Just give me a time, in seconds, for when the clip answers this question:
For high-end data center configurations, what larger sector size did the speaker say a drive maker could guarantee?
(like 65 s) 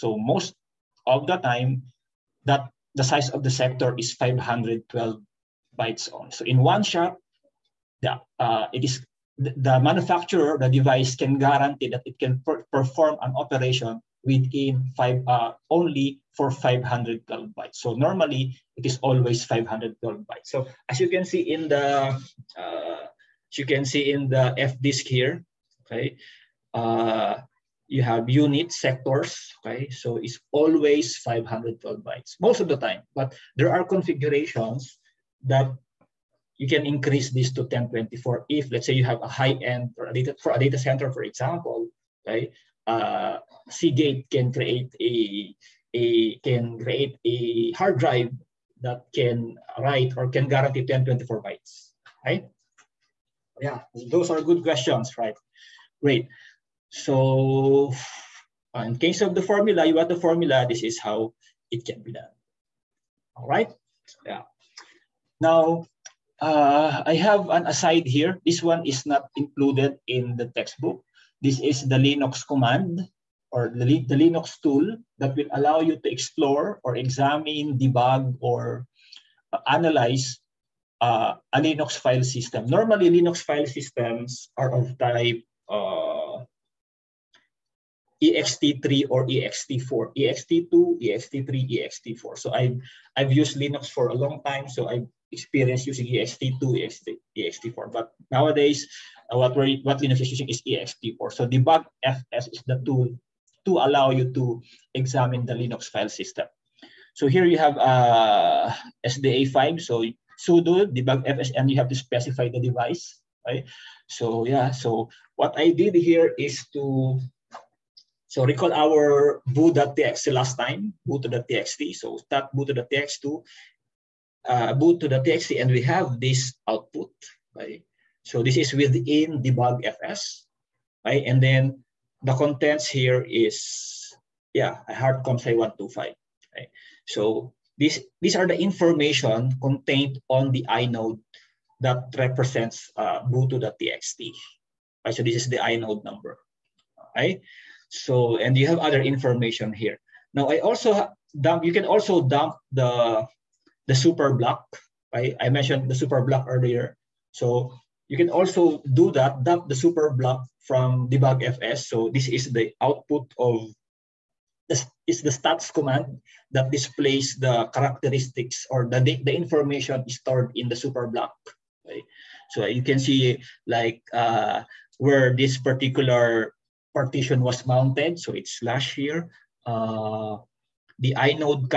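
50 s.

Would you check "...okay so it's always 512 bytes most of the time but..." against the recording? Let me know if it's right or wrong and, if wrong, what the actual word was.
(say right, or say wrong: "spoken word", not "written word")
right.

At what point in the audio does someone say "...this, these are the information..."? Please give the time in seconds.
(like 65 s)
137 s.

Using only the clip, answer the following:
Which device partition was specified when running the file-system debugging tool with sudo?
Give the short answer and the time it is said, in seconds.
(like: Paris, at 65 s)
SDA5, at 109 s.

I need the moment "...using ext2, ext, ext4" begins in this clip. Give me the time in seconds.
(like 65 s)
95 s.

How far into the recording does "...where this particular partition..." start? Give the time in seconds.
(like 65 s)
174 s.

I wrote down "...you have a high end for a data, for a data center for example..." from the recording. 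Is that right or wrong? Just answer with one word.
right.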